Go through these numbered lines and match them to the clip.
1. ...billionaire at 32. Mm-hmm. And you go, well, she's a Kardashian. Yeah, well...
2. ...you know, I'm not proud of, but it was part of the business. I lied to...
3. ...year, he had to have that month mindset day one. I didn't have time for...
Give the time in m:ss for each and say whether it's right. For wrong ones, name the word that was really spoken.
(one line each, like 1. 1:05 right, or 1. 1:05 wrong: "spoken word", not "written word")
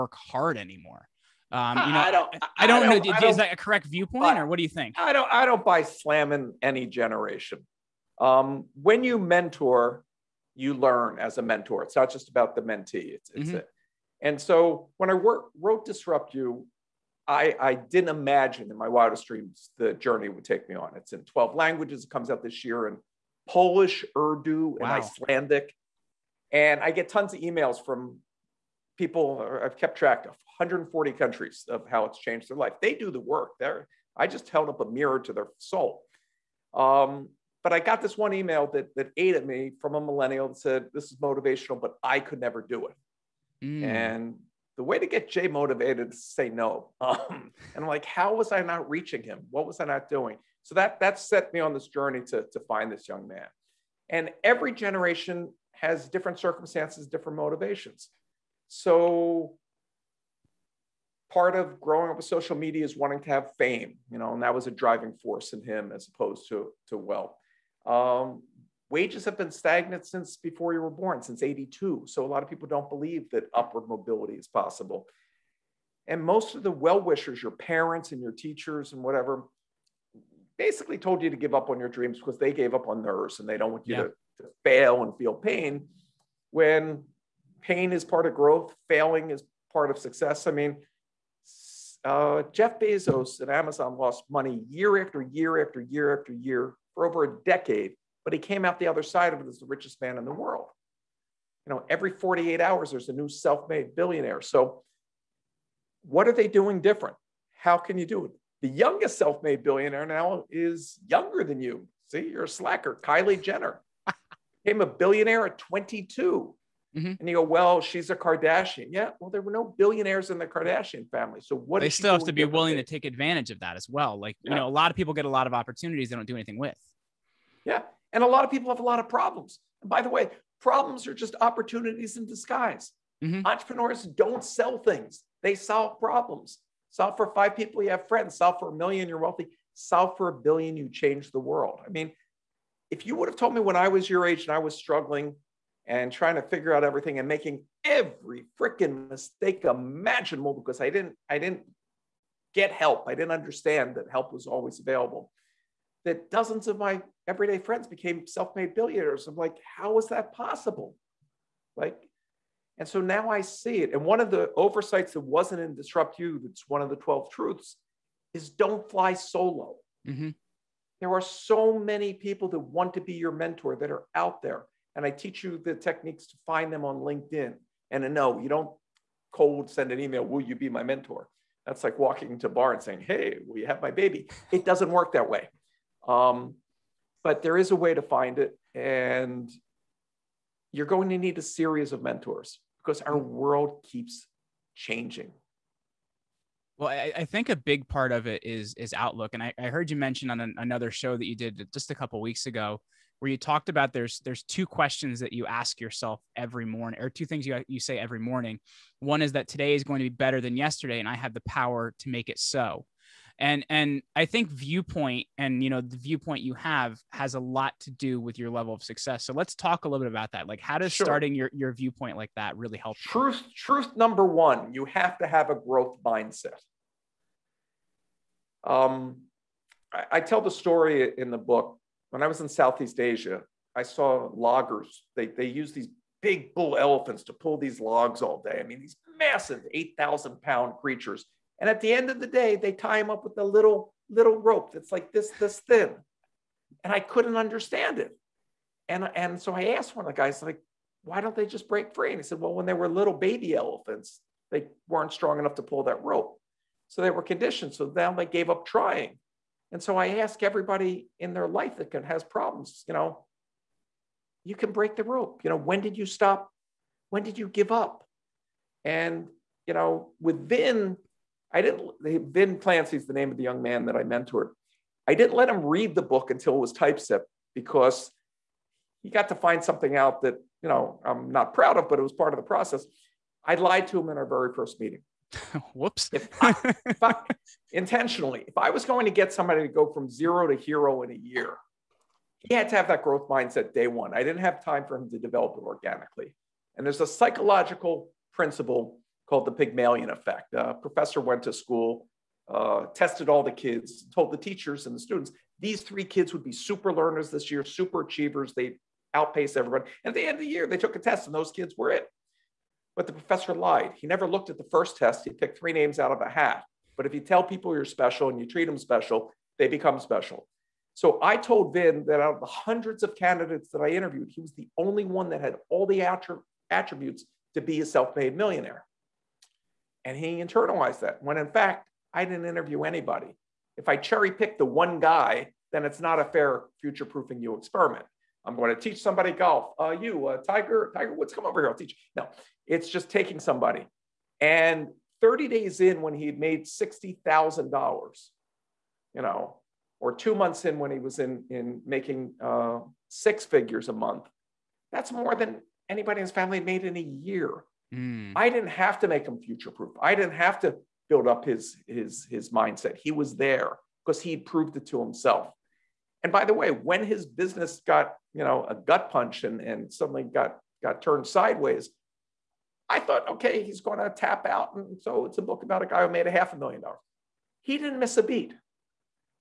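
1. 1:54 wrong: "22", not "32"
2. 4:40 wrong: "process", not "business"
3. 4:51 wrong: "growth", not "month".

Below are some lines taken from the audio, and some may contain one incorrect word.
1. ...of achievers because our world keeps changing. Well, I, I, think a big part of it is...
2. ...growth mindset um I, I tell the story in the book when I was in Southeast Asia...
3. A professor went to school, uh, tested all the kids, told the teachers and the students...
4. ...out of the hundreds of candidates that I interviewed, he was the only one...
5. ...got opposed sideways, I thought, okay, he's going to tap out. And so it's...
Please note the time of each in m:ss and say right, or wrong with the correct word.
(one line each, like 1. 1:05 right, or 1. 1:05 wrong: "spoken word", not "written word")
1. 3:11 wrong: "mentors", not "achievers"
2. 3:45 right
3. 5:00 right
4. 5:22 right
5. 6:10 wrong: "turned", not "opposed".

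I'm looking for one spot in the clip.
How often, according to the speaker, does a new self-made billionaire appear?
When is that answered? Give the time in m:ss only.
1:41.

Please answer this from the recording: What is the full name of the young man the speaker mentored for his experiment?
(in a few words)
Vin Clancy.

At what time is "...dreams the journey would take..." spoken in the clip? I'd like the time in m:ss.
0:19.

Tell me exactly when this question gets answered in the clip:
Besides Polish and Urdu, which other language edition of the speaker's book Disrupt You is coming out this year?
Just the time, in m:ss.
0:25.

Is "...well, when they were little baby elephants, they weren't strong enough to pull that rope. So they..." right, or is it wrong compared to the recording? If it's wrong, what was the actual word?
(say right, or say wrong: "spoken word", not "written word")
right.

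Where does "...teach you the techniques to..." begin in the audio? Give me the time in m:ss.
2:55.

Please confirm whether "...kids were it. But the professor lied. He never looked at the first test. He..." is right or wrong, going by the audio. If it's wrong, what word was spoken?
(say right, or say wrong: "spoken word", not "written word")
right.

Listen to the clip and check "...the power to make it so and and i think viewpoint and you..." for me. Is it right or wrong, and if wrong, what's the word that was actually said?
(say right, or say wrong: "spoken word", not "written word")
right.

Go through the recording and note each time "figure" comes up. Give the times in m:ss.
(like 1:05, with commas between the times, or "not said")
2:26, 5:53.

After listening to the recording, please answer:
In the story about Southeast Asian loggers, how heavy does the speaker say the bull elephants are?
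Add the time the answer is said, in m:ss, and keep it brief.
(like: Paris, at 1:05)
8,000 pounds, at 3:59.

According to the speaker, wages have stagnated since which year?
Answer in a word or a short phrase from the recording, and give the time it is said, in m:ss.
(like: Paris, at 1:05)
1982, at 1:11.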